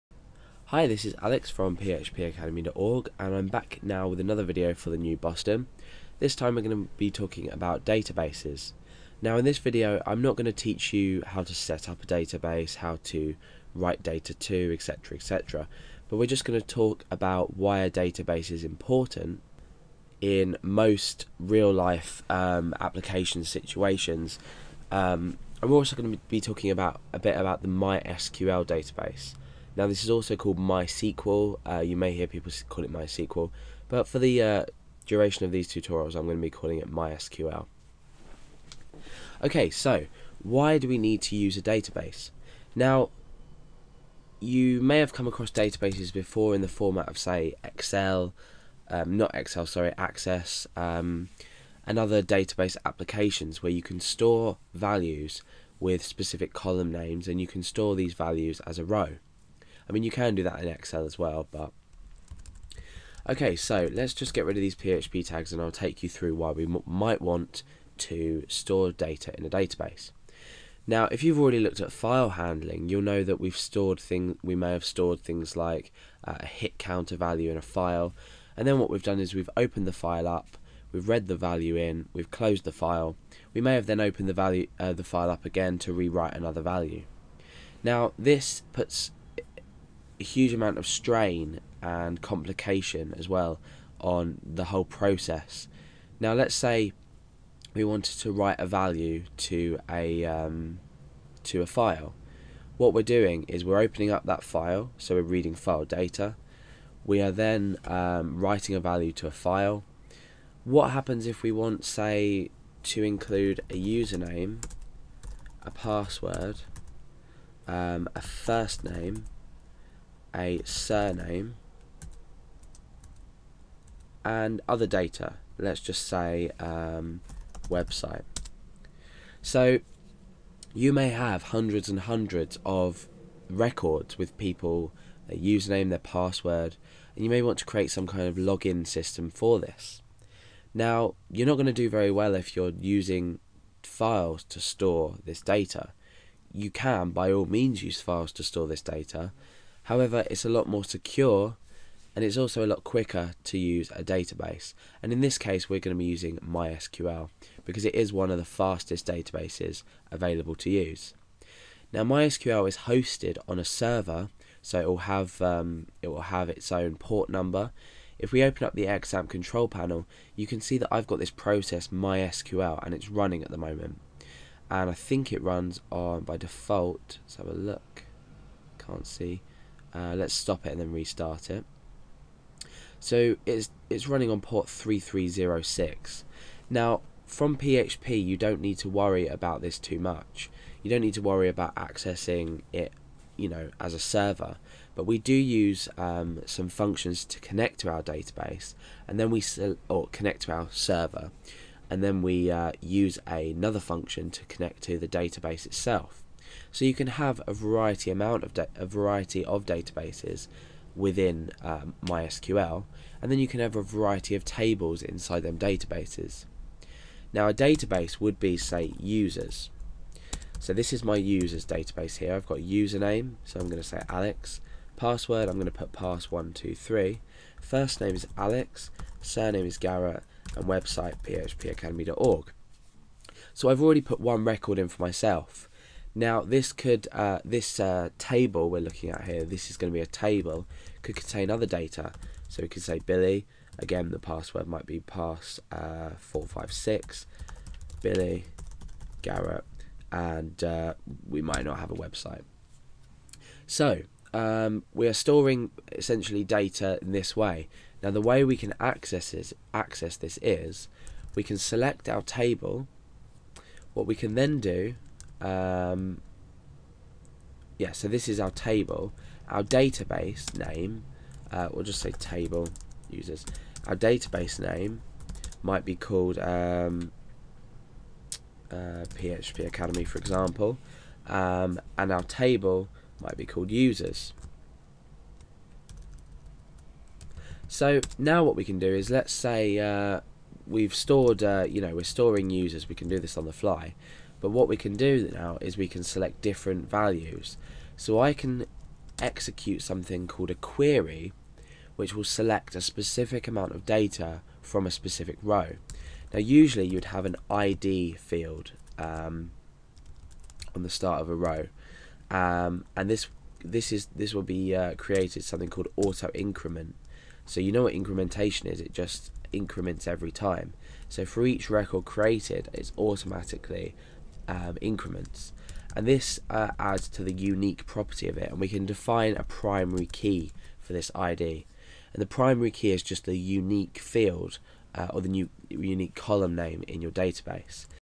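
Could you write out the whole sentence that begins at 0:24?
Um, I'm also going to be talking about a bit about the MySQL database.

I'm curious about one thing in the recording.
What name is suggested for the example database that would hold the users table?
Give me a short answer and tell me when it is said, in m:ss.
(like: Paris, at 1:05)
PHP Academy, at 4:39.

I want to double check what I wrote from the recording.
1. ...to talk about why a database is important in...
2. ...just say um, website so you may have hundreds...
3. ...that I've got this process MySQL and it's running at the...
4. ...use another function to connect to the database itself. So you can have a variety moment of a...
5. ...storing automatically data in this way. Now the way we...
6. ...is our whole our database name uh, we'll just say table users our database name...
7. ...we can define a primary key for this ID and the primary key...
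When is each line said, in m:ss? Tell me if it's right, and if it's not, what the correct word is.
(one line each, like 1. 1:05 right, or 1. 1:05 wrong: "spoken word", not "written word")
1. 0:16 right
2. 2:05 right
3. 2:50 right
4. 3:22 wrong: "amount", not "moment"
5. 4:15 wrong: "essentially", not "automatically"
6. 4:28 wrong: "table", not "whole"
7. 5:28 right.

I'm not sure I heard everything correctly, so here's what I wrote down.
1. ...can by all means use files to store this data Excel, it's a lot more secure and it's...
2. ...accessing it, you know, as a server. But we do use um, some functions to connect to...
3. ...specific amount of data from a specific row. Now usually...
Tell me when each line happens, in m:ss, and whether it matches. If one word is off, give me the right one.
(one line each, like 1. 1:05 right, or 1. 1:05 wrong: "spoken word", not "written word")
1. 2:26 wrong: "However", not "Excel"
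2. 3:11 right
3. 5:02 right.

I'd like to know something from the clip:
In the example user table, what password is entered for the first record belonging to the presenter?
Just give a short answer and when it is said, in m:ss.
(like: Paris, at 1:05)
pass123, at 3:45.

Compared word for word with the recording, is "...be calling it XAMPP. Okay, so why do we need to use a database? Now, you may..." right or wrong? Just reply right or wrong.
wrong.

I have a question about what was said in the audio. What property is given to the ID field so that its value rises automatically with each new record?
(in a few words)
auto increment.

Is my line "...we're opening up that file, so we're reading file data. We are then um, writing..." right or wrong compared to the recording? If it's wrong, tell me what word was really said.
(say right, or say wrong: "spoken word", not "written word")
right.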